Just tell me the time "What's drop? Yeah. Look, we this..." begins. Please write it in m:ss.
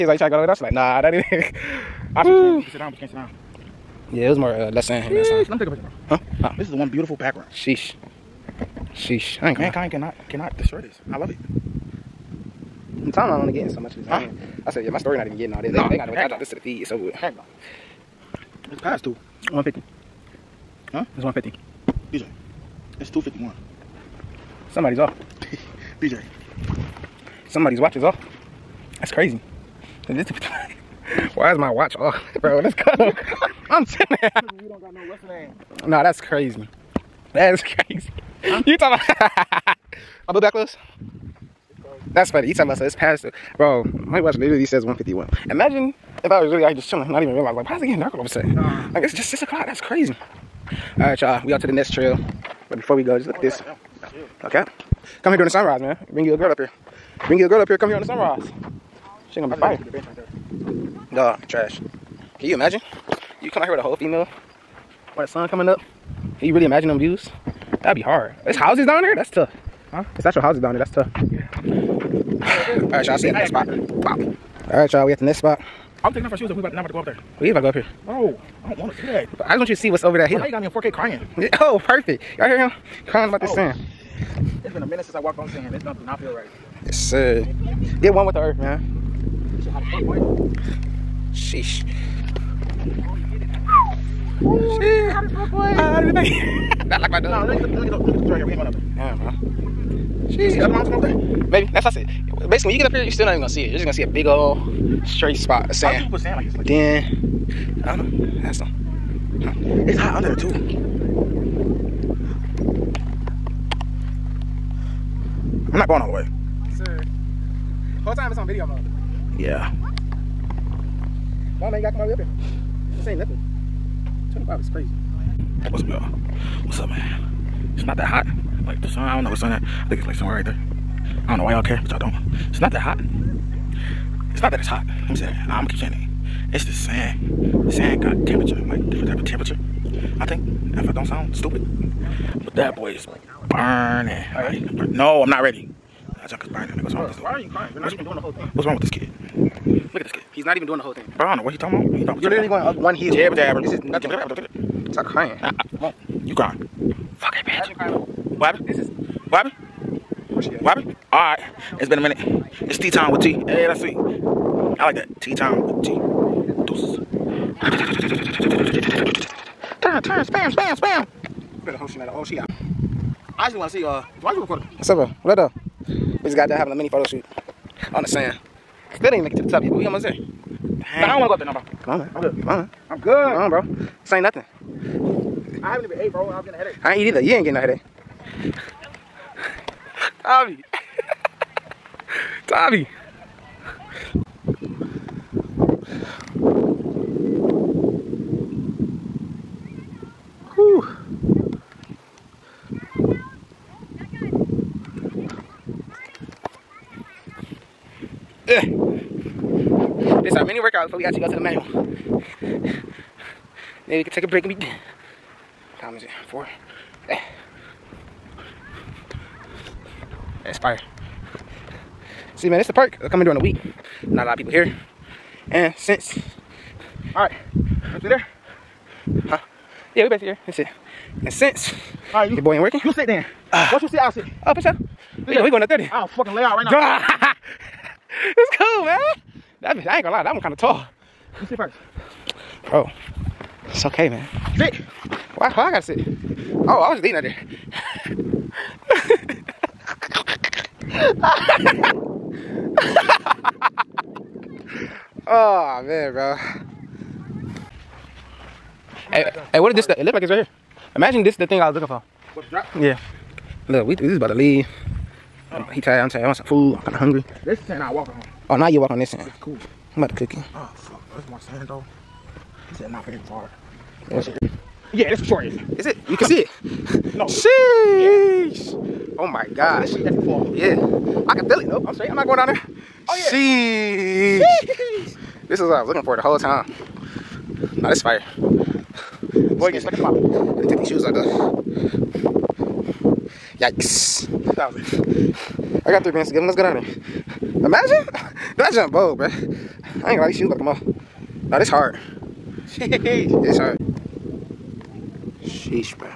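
4:22.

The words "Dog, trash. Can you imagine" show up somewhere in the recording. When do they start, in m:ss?
1:01.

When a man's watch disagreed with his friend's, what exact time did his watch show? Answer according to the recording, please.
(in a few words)
1:51.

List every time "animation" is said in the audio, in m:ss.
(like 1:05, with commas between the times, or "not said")
not said.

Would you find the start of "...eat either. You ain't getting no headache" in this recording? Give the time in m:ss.
3:06.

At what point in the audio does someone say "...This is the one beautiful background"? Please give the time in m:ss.
0:06.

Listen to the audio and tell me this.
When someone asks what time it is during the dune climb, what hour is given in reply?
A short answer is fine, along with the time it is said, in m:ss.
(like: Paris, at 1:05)
Four, at 3:36.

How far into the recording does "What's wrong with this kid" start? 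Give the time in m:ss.
2:28.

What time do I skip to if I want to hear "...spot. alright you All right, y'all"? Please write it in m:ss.
1:13.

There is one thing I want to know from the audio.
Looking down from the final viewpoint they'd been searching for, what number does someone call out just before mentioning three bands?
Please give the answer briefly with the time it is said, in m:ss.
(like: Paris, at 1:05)
2,000, at 4:54.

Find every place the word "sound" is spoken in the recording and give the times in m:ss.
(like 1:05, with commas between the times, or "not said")
2:21.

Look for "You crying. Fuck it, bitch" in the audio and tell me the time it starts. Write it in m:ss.
2:36.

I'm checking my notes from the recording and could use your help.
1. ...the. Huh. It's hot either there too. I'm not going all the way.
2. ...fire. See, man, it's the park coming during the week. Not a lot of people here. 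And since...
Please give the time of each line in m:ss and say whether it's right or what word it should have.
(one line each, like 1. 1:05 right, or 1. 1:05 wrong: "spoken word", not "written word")
1. 1:48 wrong: "under", not "either"
2. 3:40 right.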